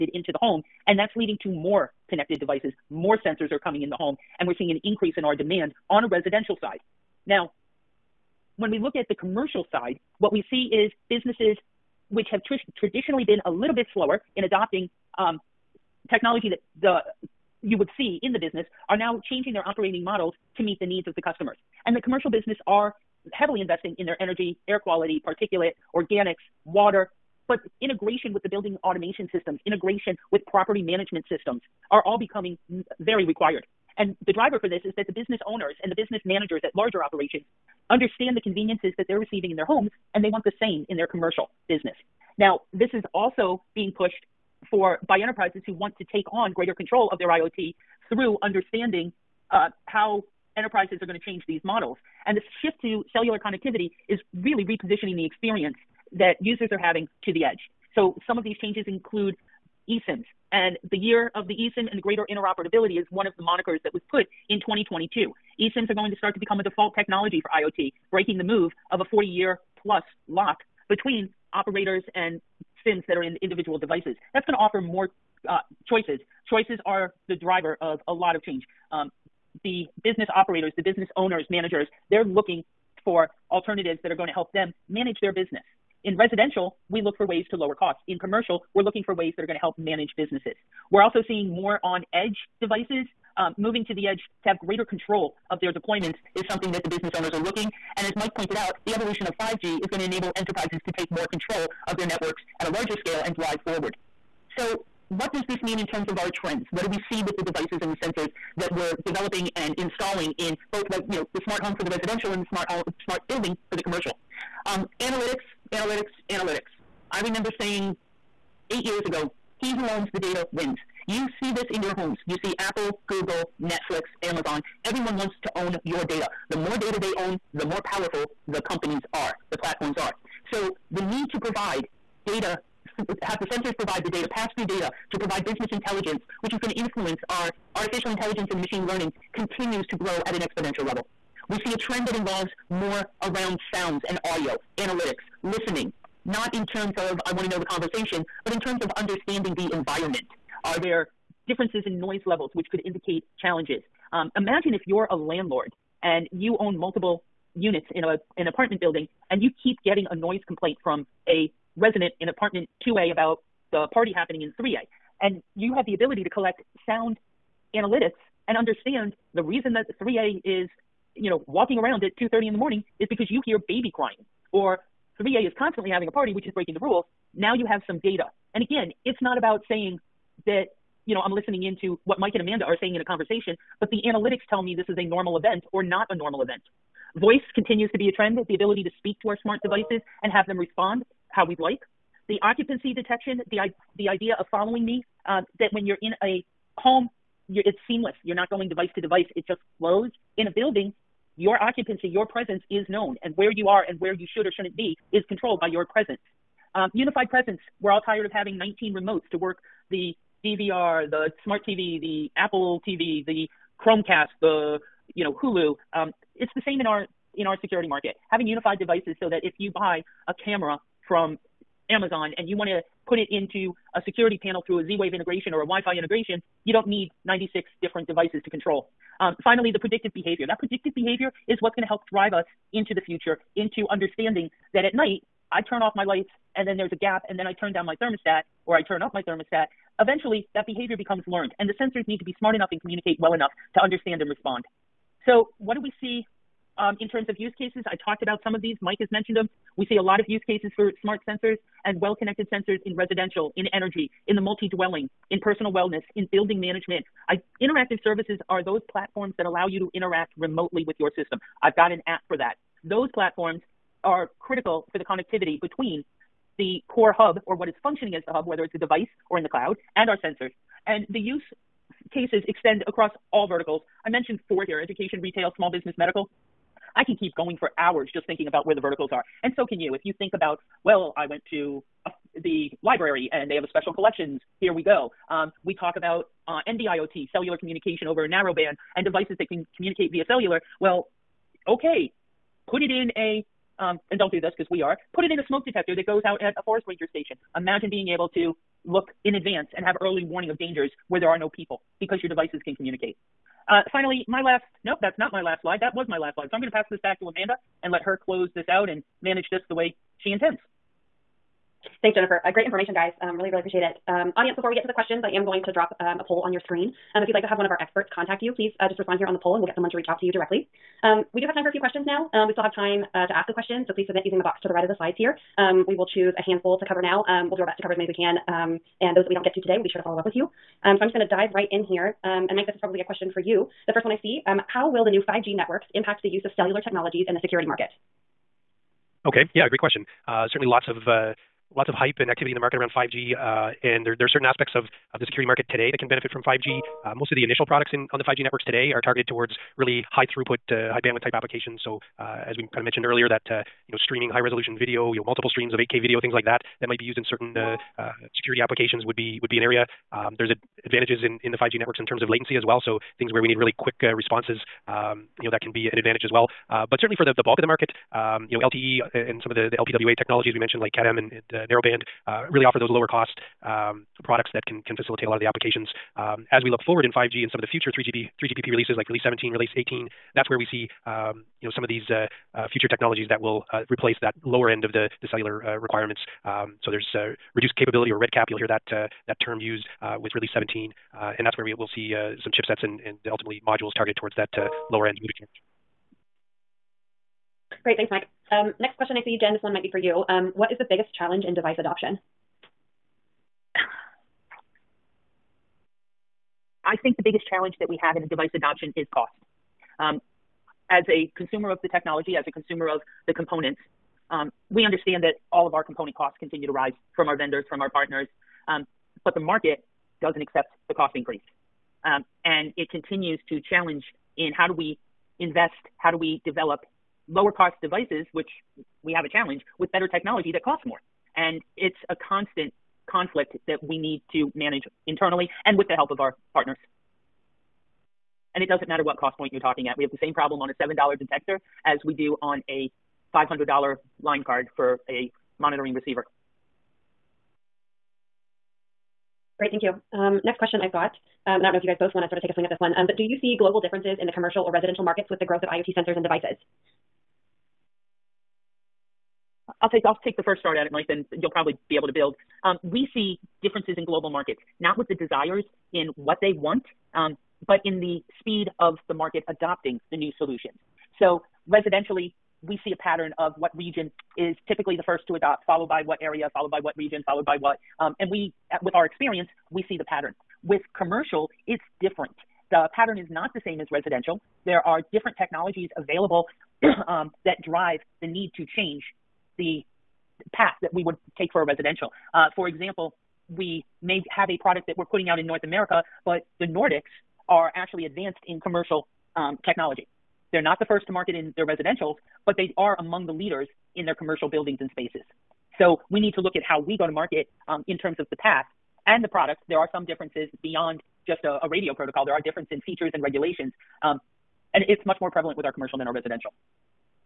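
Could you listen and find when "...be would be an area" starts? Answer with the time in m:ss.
5:59.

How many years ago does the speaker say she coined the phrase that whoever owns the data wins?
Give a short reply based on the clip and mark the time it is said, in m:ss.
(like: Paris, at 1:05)
8, at 1:58.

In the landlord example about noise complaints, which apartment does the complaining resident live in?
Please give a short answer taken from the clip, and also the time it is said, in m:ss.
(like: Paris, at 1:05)
2A, at 2:42.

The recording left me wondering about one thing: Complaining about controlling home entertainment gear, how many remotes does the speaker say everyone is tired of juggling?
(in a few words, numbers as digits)
19.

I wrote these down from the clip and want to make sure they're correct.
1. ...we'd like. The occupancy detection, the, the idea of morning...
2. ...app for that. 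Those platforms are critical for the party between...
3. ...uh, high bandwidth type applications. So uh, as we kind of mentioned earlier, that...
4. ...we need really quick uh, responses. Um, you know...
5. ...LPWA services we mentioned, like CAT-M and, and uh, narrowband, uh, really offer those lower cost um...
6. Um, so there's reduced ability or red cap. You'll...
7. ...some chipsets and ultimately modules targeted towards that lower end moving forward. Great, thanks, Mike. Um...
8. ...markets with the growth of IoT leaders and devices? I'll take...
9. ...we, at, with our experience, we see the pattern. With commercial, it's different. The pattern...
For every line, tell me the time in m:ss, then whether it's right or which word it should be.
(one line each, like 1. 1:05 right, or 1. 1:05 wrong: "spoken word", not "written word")
1. 3:11 wrong: "following", not "morning"
2. 4:22 wrong: "connectivity", not "party"
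3. 5:50 right
4. 6:03 right
5. 6:09 wrong: "technologies", not "services"
6. 6:26 wrong: "capability", not "ability"
7. 6:32 right
8. 7:35 wrong: "sensors", not "leaders"
9. 7:58 right.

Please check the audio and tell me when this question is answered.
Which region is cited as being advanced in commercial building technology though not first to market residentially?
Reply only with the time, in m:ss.
8:16.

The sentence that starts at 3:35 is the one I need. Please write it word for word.
Um, it's the same in our in our security market.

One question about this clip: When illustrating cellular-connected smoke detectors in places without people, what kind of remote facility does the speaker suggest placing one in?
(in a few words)
forest ranger station.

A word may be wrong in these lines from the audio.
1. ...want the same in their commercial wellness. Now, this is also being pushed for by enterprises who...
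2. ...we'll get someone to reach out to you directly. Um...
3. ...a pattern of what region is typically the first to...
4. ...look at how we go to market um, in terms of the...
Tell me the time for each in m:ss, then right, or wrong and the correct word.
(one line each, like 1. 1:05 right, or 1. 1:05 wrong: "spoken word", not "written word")
1. 0:40 wrong: "business", not "wellness"
2. 5:19 right
3. 7:52 right
4. 8:26 right.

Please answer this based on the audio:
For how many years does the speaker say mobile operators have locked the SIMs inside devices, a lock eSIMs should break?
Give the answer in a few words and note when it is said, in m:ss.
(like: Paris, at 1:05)
40 years, at 1:09.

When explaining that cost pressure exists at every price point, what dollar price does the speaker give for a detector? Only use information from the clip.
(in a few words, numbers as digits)
$7.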